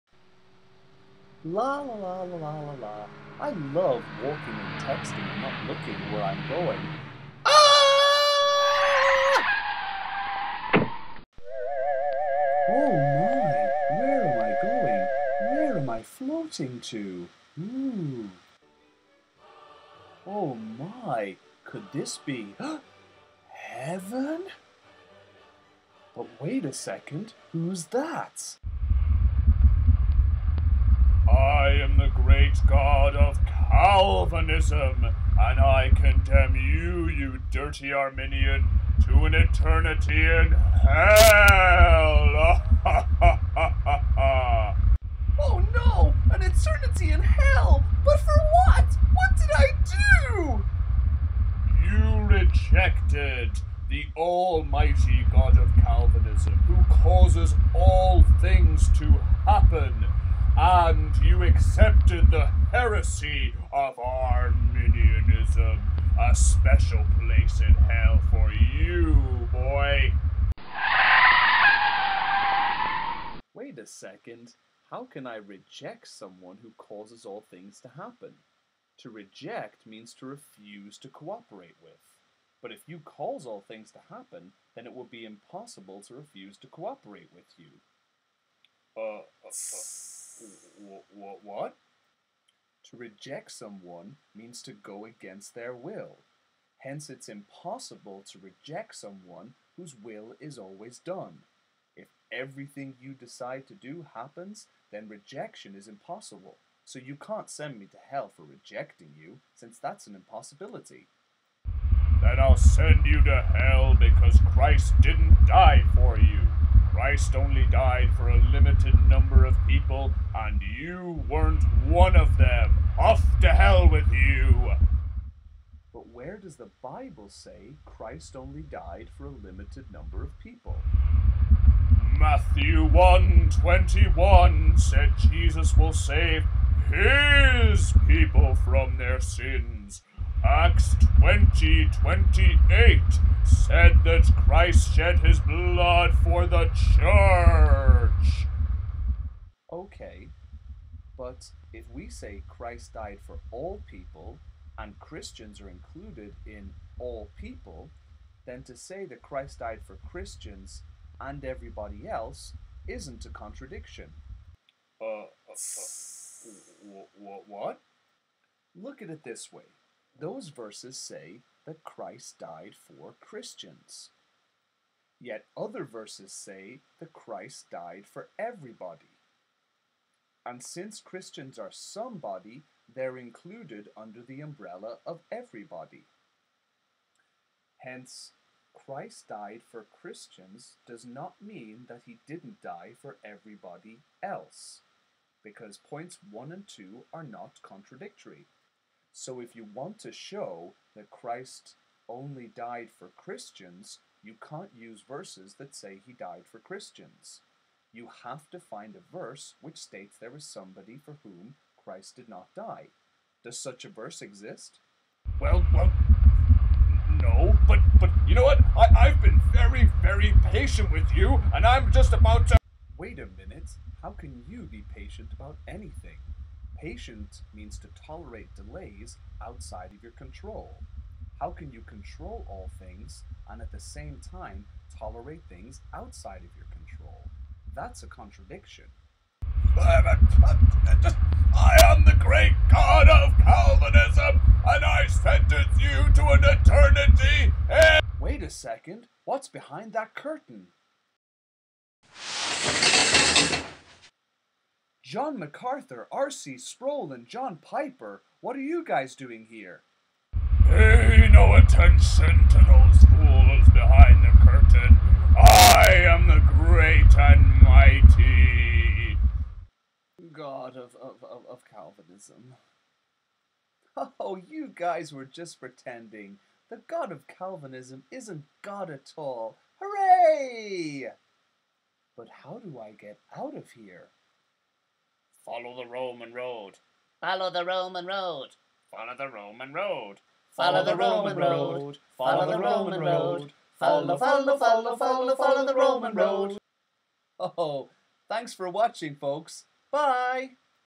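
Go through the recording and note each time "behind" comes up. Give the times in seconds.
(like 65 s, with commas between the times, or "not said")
249 s, 263 s.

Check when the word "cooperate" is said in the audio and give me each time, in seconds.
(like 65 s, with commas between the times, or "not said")
81 s, 86 s.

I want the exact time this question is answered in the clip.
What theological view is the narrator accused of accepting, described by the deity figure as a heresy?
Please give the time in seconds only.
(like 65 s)
63 s.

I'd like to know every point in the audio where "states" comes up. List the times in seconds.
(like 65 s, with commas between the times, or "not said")
209 s.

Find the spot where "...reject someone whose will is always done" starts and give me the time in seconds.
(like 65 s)
98 s.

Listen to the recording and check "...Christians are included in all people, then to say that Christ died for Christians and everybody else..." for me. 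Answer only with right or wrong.
right.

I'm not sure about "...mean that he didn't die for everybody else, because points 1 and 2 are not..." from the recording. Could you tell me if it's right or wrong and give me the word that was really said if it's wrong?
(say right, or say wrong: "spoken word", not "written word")
right.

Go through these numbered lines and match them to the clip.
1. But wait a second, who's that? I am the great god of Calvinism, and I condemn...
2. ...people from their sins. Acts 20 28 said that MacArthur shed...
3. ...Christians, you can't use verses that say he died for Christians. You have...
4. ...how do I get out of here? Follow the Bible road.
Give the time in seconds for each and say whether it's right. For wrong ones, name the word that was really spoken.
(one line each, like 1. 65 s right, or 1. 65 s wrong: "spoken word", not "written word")
1. 26 s right
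2. 138 s wrong: "Christ", not "MacArthur"
3. 203 s right
4. 282 s wrong: "Roman", not "Bible".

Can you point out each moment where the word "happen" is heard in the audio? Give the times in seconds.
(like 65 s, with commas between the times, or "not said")
59 s, 77 s, 84 s, 104 s.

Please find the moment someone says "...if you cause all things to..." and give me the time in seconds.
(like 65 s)
82 s.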